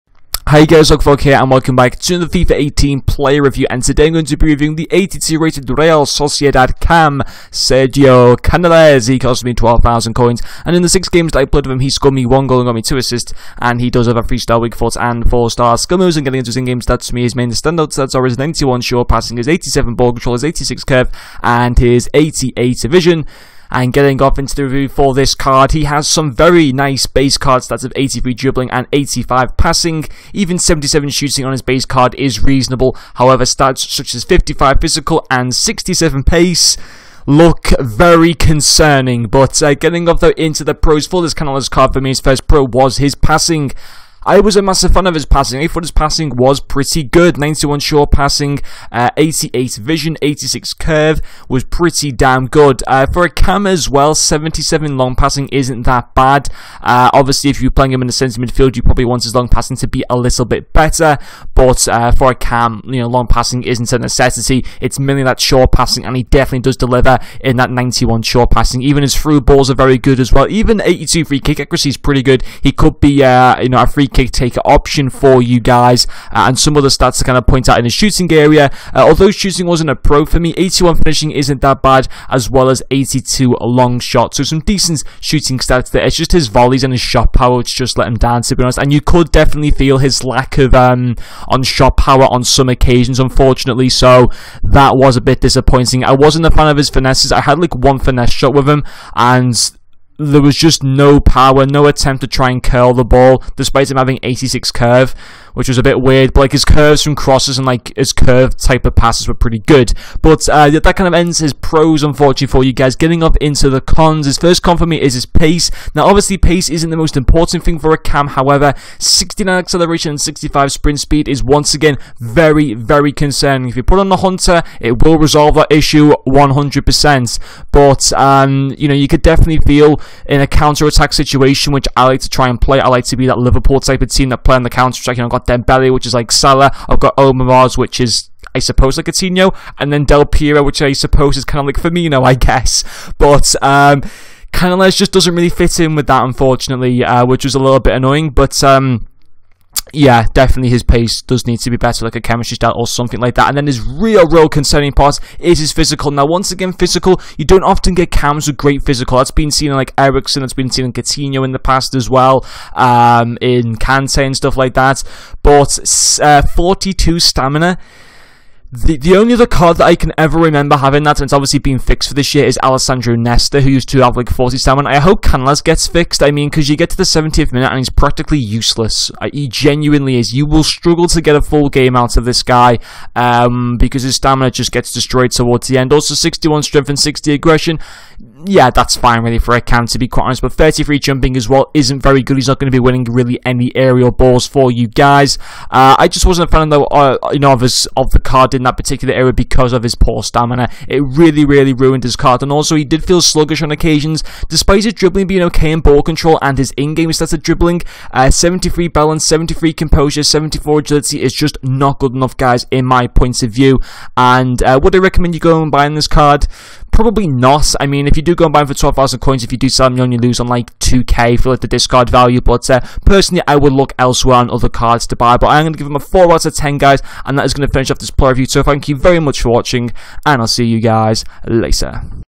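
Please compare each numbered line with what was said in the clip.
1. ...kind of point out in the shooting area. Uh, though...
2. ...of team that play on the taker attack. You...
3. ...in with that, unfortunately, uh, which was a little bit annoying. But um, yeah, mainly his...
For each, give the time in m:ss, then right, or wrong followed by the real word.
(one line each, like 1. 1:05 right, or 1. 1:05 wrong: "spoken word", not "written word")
1. 1:17 wrong: "although", not "though"
2. 2:14 wrong: "counter", not "taker"
3. 2:25 wrong: "definitely", not "mainly".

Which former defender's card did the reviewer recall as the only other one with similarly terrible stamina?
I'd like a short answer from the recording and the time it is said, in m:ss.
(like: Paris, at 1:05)
Alessandro Nesta, at 2:52.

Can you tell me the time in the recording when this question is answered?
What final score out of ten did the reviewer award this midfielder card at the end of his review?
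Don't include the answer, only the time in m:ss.
3:46.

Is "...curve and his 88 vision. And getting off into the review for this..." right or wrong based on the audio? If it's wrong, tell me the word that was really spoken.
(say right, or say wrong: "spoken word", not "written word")
right.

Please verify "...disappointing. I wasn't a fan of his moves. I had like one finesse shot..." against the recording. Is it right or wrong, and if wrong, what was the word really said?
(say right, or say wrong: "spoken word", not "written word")
wrong: "finesses", not "moves".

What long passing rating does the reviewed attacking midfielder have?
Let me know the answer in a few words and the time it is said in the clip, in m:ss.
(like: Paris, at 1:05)
77, at 0:54.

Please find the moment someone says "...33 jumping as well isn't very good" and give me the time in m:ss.
3:10.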